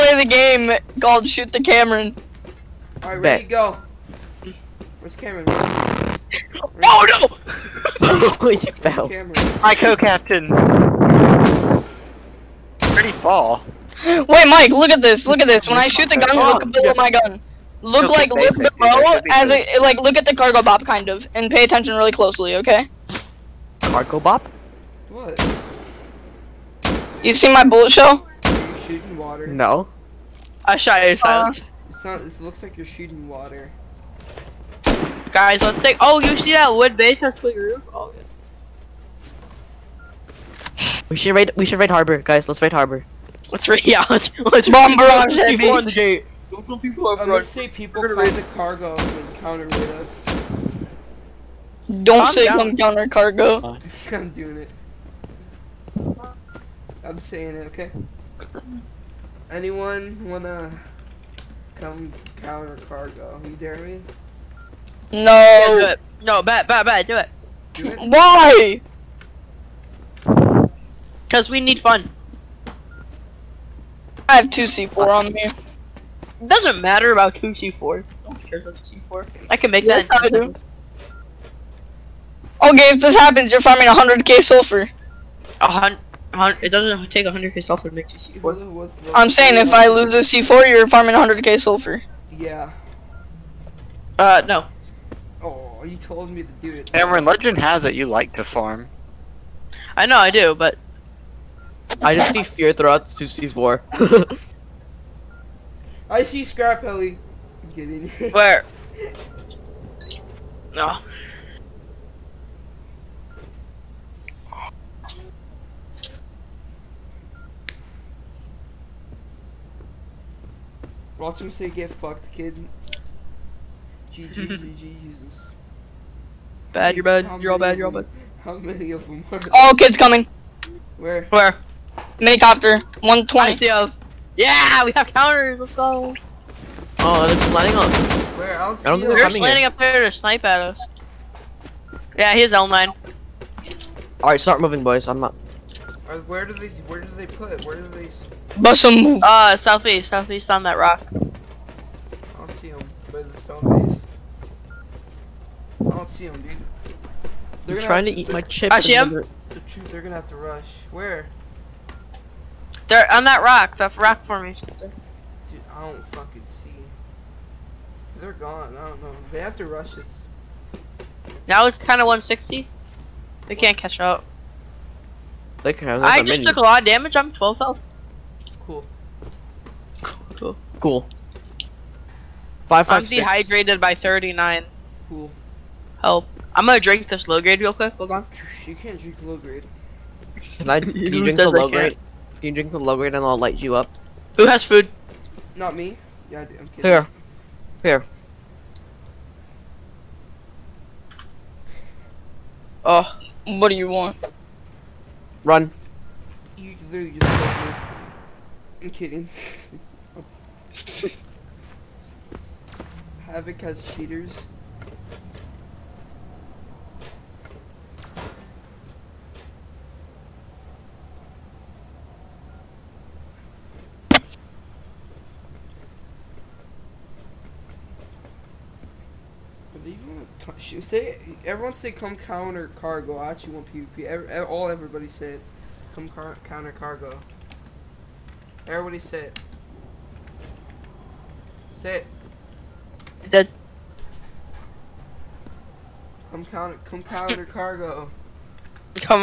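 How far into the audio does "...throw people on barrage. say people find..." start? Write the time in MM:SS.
00:46.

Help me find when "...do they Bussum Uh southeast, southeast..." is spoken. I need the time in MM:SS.
02:27.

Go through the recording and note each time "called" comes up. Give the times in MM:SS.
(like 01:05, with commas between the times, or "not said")
00:01.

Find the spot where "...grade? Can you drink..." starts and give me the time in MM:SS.
03:11.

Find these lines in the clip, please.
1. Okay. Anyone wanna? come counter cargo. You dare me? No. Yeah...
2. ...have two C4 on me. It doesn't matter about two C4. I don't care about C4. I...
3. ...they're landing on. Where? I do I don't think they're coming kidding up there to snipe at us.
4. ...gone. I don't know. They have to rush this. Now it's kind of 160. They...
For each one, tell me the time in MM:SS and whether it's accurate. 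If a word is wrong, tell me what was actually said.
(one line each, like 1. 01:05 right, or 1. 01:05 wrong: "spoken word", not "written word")
1. 00:57 right
2. 01:14 right
3. 02:17 wrong: "landing", not "kidding"
4. 02:48 right.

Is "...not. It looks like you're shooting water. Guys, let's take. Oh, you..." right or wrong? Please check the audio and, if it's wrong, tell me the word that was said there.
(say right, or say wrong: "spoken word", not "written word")
right.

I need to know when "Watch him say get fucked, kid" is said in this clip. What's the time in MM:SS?
02:01.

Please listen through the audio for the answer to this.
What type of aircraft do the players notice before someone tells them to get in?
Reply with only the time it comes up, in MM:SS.
01:46.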